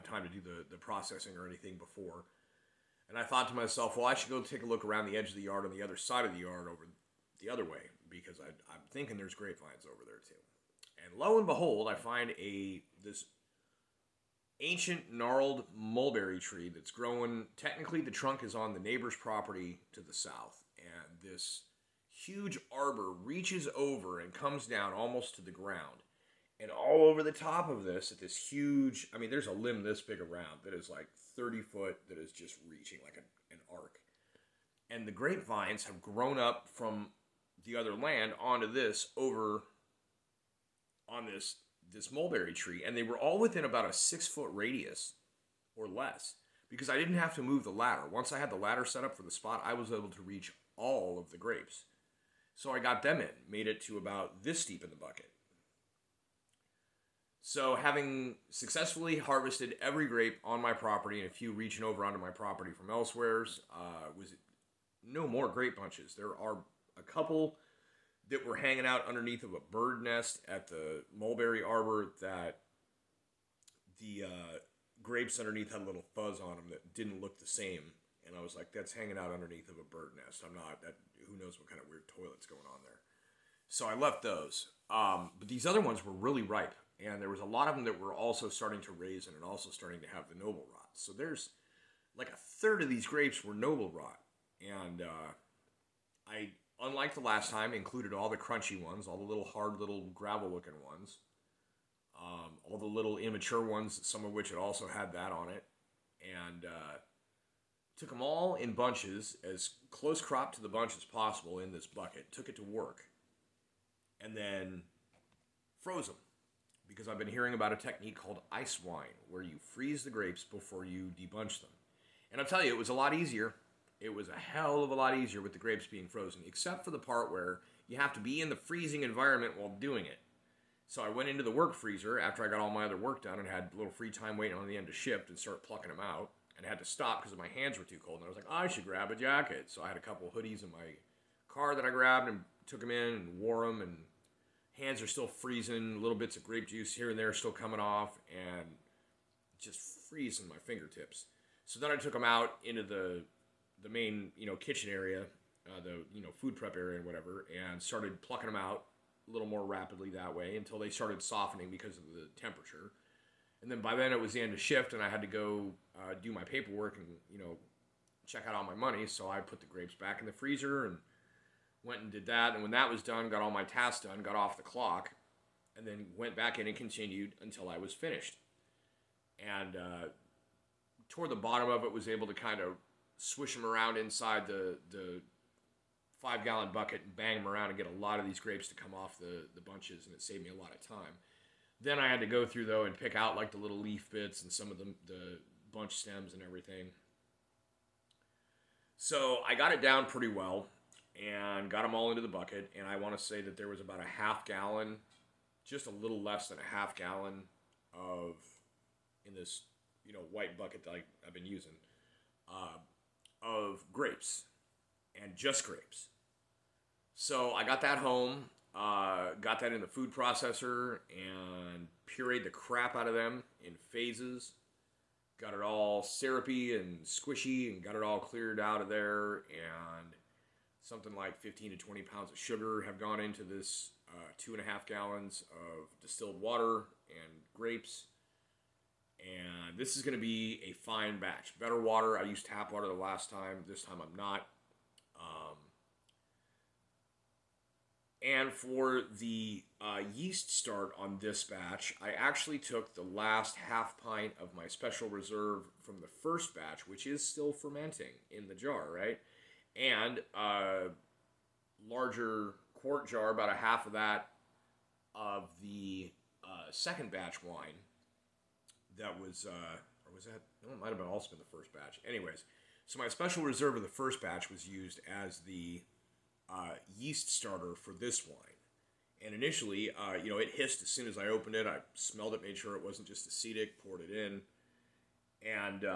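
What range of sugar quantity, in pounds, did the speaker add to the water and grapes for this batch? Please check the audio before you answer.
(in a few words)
15 to 20 pounds.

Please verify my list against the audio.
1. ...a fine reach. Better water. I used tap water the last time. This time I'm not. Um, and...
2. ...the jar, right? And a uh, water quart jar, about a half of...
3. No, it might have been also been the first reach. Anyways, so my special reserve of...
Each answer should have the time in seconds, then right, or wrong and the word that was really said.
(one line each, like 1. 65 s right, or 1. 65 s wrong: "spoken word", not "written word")
1. 240 s wrong: "batch", not "reach"
2. 258 s wrong: "larger", not "water"
3. 270 s wrong: "batch", not "reach".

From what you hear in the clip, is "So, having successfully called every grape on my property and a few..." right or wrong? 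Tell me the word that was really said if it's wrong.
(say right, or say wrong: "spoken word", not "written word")
wrong: "harvested", not "called".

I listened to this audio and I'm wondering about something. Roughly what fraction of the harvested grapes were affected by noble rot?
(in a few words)
a third.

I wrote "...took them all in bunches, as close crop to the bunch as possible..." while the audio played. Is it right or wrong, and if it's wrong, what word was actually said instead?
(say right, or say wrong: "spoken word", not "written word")
right.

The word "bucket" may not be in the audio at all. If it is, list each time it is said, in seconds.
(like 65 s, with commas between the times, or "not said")
54 s, 111 s, 186 s, 202 s, 210 s.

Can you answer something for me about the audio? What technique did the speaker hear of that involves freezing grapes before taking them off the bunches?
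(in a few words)
ice wine.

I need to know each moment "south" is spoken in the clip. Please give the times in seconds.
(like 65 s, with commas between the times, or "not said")
20 s.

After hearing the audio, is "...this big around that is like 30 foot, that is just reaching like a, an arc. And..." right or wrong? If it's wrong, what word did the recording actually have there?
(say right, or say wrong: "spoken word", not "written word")
right.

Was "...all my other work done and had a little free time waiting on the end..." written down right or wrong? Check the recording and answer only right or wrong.
right.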